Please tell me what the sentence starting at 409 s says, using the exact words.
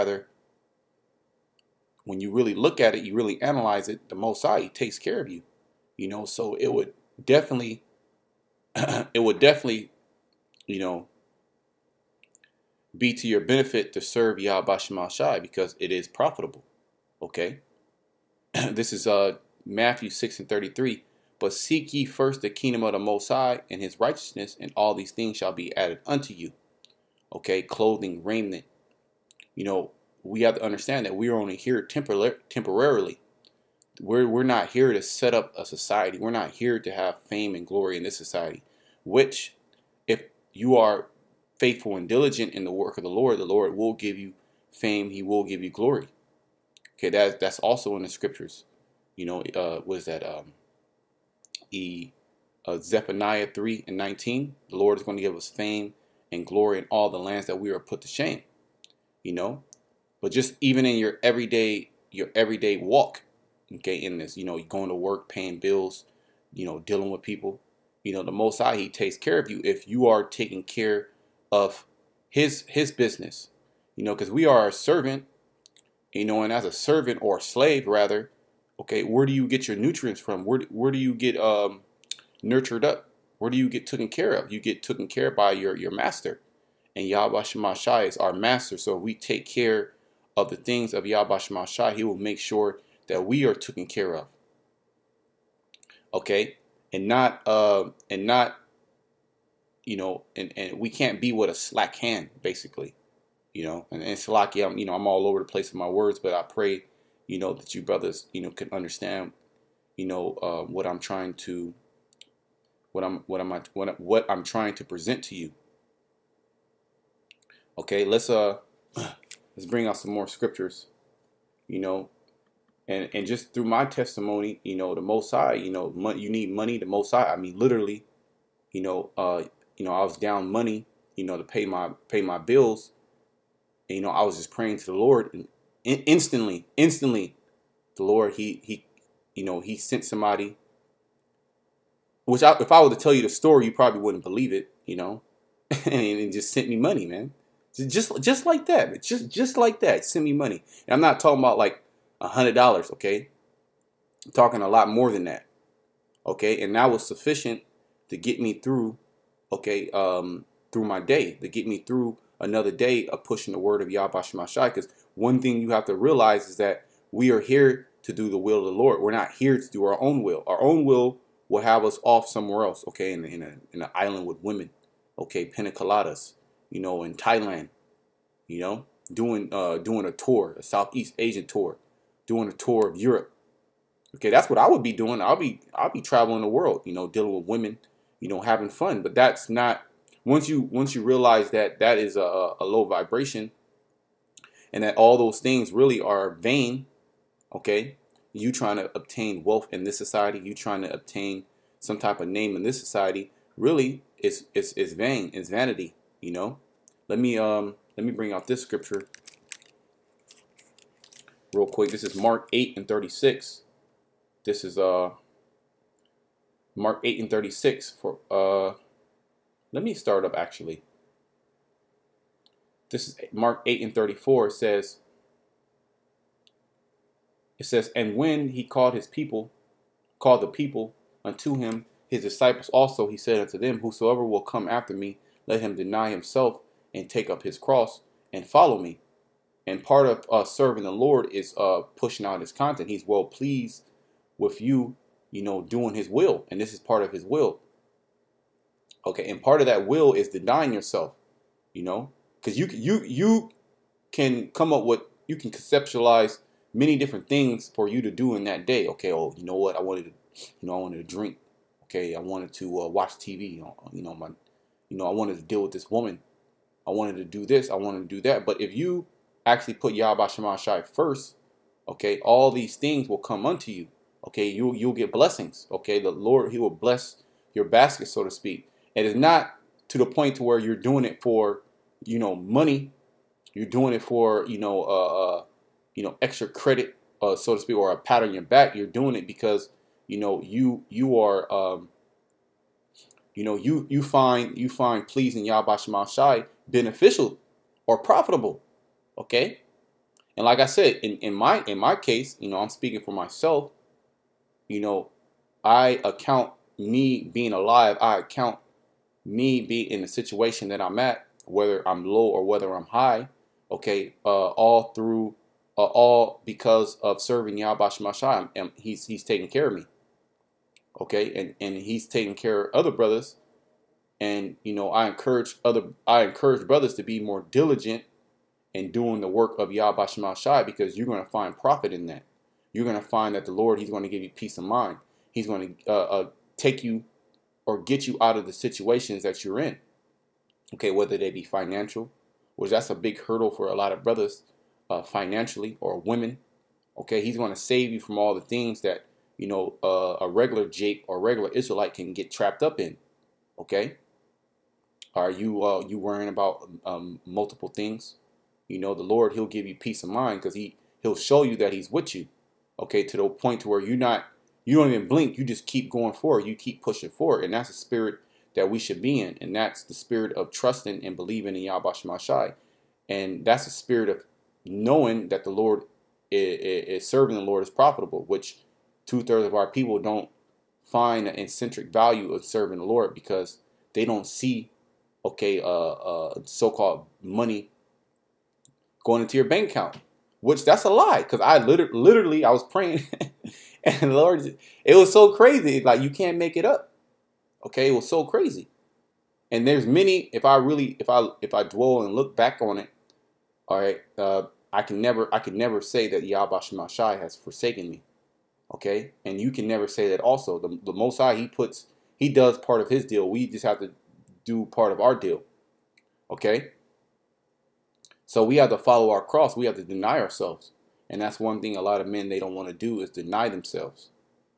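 And you can never say that.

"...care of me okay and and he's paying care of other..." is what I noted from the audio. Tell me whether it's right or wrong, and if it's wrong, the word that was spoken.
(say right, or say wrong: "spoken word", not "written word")
wrong: "taking", not "paying".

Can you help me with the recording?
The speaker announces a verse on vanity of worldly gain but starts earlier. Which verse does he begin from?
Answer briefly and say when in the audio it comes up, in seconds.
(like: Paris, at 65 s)
Mark 8:34, at 223 s.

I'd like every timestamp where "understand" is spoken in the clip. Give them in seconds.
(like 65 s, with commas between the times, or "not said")
30 s, 108 s.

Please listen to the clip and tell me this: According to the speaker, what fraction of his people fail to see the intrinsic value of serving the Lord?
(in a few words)
two thirds.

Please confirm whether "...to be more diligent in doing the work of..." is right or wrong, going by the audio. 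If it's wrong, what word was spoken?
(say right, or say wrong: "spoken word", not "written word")
right.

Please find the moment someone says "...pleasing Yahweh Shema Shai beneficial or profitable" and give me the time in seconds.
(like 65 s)
295 s.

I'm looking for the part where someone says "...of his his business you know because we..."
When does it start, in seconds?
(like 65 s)
71 s.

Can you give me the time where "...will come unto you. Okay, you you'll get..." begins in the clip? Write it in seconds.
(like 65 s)
273 s.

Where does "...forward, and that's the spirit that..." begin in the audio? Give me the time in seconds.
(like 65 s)
367 s.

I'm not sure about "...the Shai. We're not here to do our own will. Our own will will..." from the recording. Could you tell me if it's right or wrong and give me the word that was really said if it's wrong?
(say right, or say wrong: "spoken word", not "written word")
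wrong: "Lord", not "Shai".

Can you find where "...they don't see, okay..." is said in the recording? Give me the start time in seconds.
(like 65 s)
383 s.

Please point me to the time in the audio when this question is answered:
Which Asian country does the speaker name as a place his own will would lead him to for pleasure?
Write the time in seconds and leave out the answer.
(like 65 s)
177 s.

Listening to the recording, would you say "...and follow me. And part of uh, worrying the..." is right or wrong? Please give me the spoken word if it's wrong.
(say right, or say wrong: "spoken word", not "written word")
wrong: "serving", not "worrying".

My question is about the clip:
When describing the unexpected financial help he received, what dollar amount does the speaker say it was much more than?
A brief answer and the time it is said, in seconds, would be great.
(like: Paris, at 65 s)
100 dollars, at 152 s.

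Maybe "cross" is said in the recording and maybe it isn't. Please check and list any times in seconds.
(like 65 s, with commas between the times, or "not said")
237 s, 419 s.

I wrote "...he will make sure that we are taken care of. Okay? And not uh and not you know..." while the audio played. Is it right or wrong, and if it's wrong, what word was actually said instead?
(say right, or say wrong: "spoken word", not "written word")
right.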